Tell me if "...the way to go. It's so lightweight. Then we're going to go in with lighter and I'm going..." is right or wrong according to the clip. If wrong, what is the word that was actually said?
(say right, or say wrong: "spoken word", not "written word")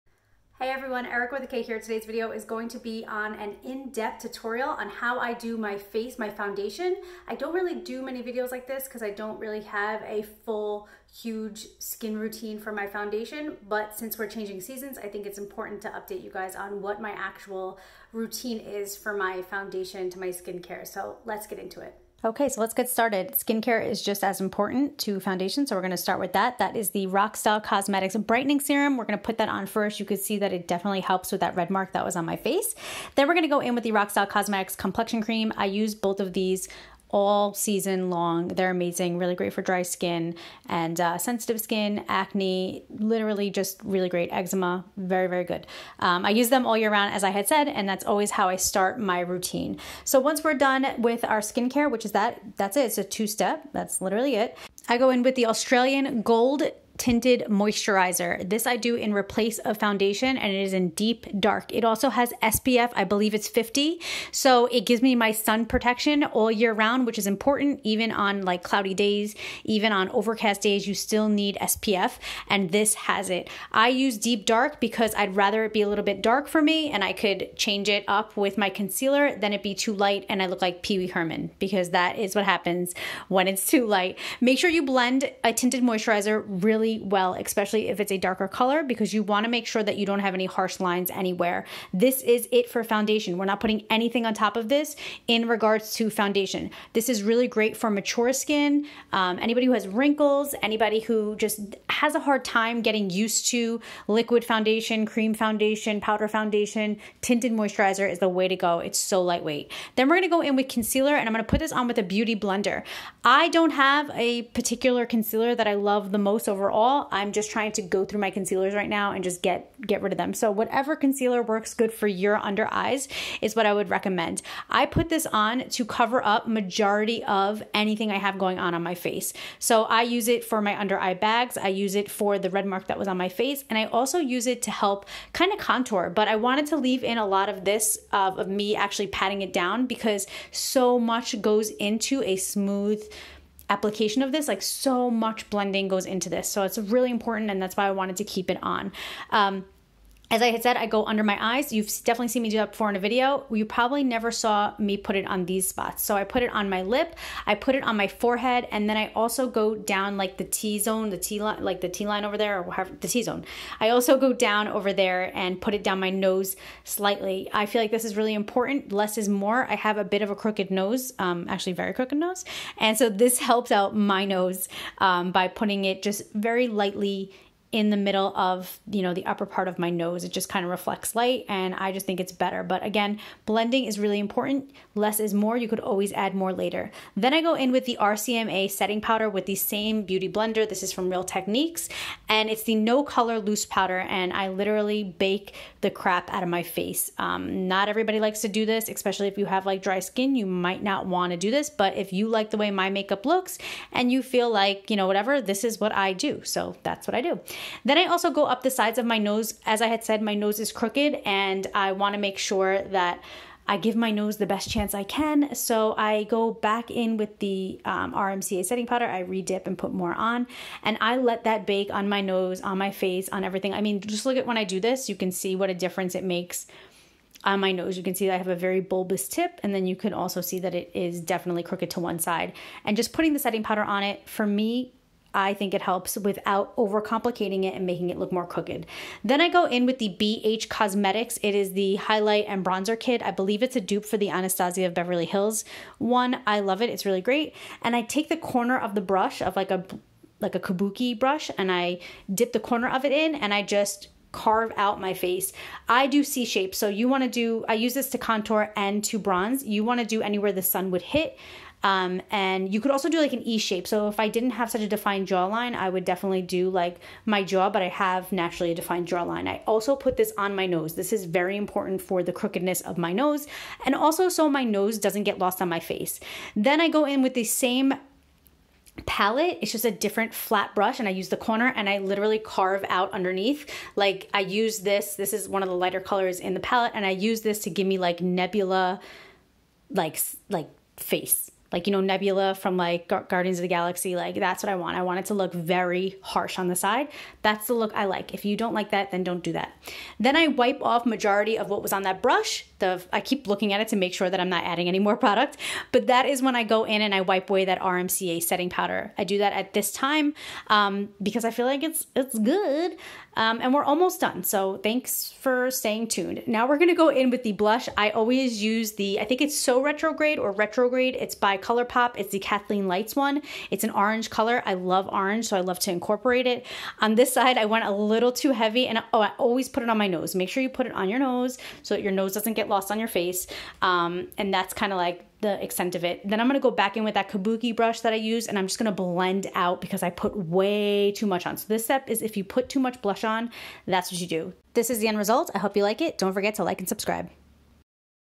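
wrong: "concealer", not "lighter".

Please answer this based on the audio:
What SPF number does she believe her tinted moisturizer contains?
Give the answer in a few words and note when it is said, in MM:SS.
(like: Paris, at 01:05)
50, at 01:02.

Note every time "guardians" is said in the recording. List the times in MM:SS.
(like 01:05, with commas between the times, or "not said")
04:53.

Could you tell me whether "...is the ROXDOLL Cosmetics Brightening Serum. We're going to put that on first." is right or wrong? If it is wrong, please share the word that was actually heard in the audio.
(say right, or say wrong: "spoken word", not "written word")
right.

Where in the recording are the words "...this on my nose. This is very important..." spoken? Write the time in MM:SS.
04:30.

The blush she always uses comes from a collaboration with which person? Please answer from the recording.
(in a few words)
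Kathleen Lights.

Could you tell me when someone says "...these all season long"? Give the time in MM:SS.
00:36.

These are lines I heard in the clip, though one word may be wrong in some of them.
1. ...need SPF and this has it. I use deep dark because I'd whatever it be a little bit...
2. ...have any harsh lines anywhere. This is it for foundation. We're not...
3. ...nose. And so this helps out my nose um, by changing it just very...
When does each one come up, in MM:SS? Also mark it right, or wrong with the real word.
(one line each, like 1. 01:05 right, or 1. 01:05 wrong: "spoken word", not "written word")
1. 01:11 wrong: "rather", not "whatever"
2. 01:30 right
3. 02:52 wrong: "putting", not "changing".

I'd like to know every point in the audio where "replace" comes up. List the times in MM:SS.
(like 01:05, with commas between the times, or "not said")
00:59.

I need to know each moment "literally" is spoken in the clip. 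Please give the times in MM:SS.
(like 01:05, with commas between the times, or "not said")
00:42, 00:54, 03:14, 04:41.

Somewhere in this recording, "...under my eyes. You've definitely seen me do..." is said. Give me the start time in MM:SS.
02:31.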